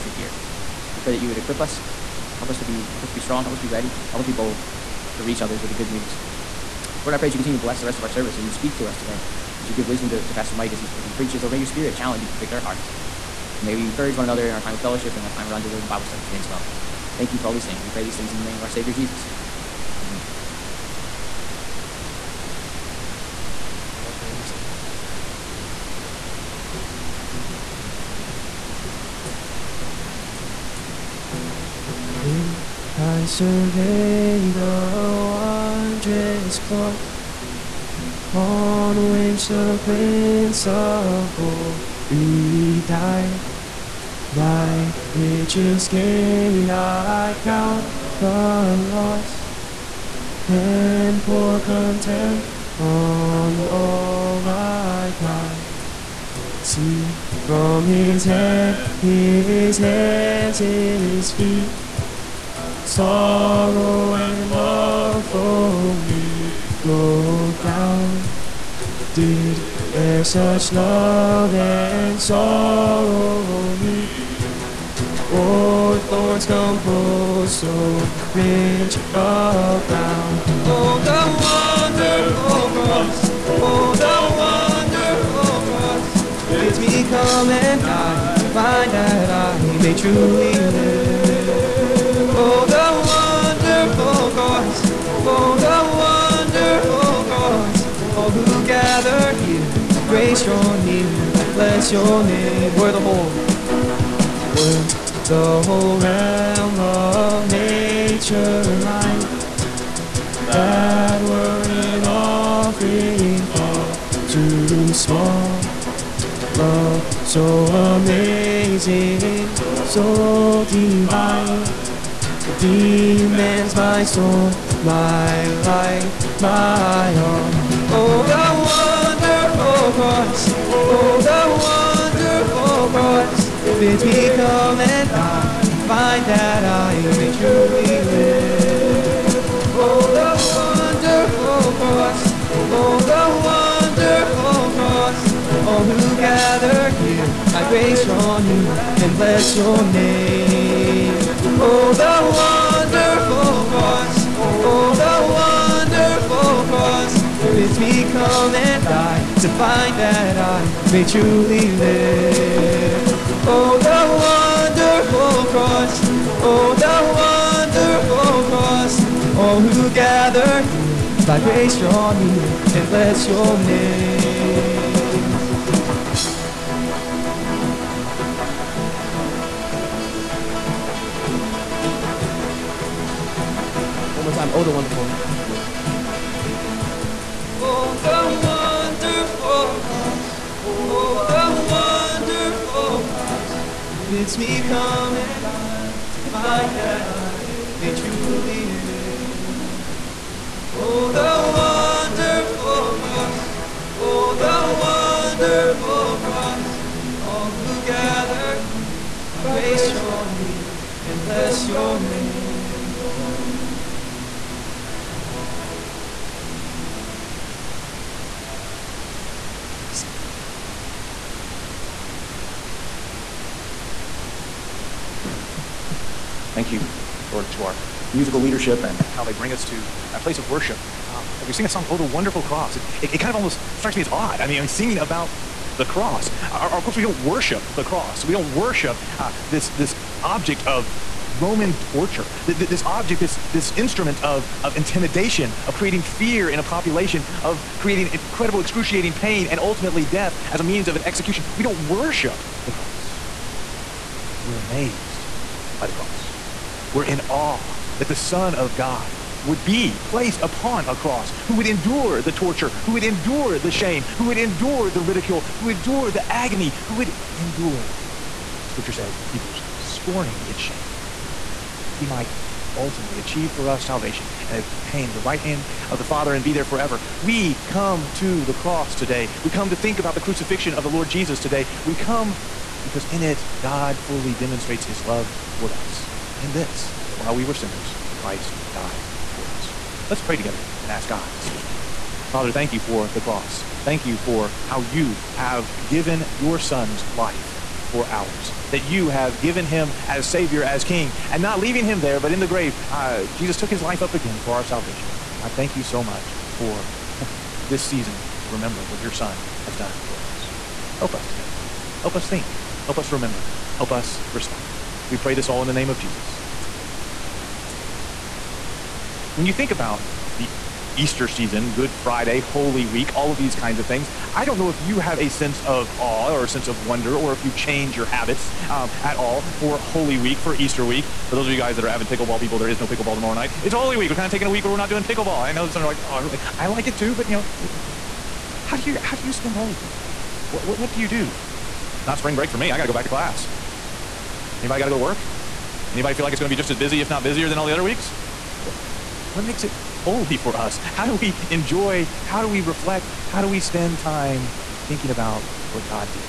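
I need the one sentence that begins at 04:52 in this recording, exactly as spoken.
Father, thank you for the cross.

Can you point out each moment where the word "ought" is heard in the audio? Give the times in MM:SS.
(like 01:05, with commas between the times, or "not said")
not said.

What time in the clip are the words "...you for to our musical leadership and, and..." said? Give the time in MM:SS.
03:46.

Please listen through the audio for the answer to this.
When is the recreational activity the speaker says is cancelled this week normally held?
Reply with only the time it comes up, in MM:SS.
05:33.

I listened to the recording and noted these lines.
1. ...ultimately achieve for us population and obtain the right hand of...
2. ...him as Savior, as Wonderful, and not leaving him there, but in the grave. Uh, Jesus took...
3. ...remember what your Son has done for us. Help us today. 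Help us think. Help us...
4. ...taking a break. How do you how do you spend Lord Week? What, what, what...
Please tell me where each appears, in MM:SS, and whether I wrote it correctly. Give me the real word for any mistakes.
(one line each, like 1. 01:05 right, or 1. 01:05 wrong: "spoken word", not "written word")
1. 04:32 wrong: "salvation", not "population"
2. 04:59 wrong: "King", not "Wonderful"
3. 05:08 right
4. 05:37 wrong: "Holy", not "Lord".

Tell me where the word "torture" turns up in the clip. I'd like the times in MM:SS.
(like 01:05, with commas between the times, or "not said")
04:01, 04:22.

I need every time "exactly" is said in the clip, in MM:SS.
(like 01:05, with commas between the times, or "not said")
not said.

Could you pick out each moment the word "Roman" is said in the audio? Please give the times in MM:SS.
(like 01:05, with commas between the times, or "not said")
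04:01.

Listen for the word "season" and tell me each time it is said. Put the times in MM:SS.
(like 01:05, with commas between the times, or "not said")
05:07, 05:21.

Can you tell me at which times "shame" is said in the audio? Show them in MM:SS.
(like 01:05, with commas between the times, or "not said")
04:23, 04:30.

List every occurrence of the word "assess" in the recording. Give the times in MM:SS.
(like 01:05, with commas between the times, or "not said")
not said.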